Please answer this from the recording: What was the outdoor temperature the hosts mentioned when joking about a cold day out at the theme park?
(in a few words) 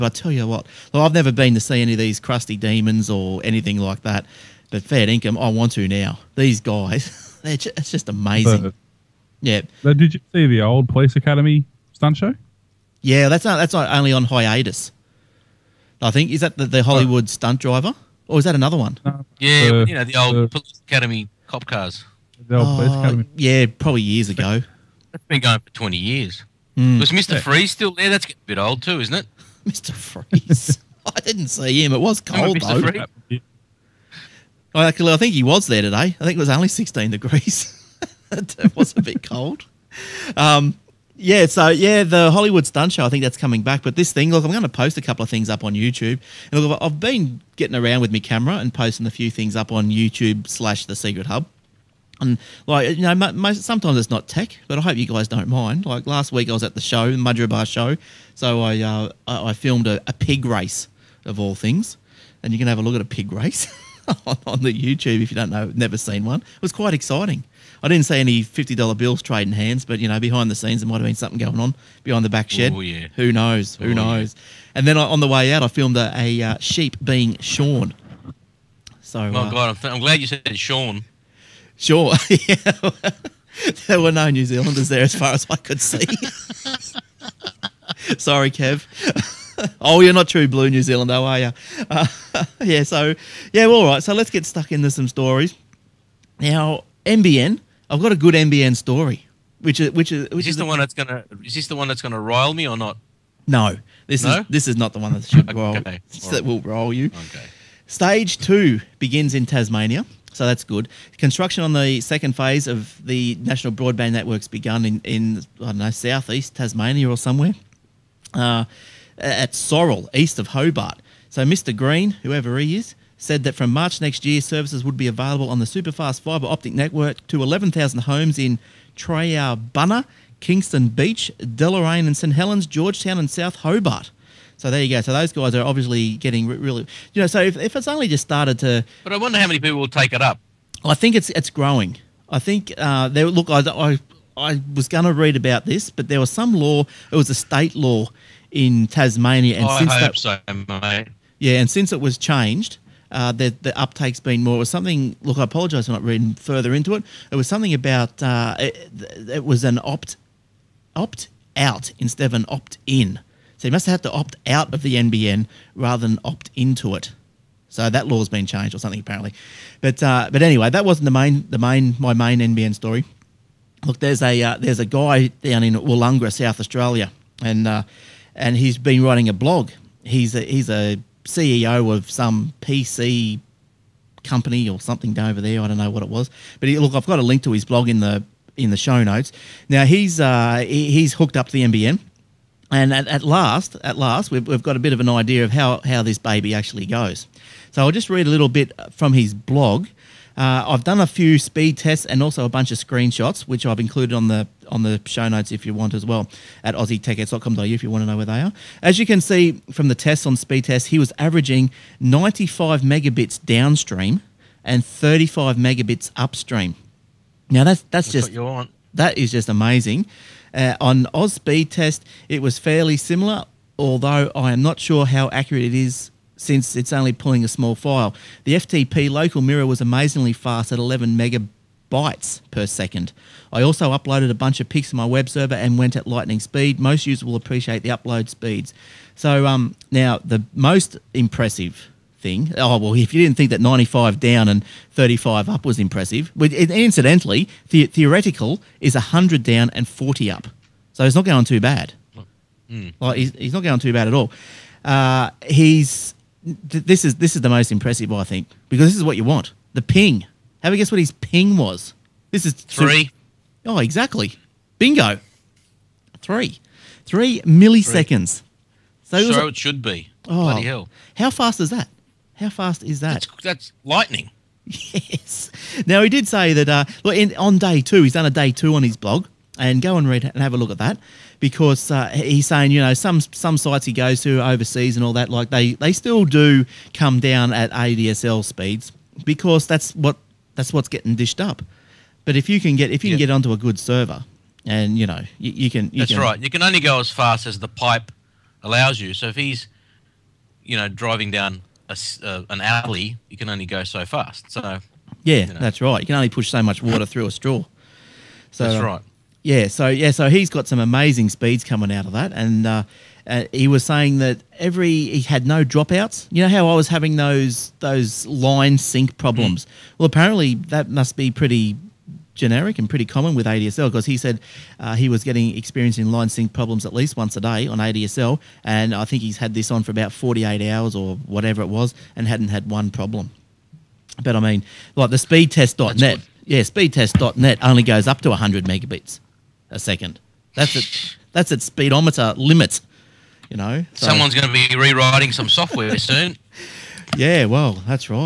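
16 degrees.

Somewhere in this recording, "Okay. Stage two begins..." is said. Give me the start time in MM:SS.
01:47.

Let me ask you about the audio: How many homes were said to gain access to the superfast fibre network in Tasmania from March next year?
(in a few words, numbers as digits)
11,000.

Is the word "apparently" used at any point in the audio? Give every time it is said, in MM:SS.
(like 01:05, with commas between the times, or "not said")
02:48, 05:20.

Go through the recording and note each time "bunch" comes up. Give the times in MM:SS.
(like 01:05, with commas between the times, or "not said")
03:22, 03:54.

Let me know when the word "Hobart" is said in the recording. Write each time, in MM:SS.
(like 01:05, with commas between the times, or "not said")
02:00, 02:13.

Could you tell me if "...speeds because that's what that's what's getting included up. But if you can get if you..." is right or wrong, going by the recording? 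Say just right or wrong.
wrong.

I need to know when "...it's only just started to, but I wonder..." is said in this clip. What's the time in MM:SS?
02:17.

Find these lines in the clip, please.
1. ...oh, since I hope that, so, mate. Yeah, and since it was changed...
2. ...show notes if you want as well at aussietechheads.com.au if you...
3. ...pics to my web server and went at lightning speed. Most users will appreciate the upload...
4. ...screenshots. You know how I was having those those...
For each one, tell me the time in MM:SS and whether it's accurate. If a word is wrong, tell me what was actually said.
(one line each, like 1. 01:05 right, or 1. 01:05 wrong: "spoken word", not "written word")
1. 02:29 right
2. 03:25 right
3. 03:54 right
4. 05:15 wrong: "dropouts", not "screenshots".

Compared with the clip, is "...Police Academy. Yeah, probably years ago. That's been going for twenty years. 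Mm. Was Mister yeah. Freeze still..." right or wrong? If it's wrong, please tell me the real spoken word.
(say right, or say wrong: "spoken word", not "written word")
right.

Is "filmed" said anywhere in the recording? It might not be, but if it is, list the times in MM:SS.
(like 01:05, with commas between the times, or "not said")
00:59, 01:15.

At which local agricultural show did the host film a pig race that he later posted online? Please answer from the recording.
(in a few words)
Mudgeeraba show.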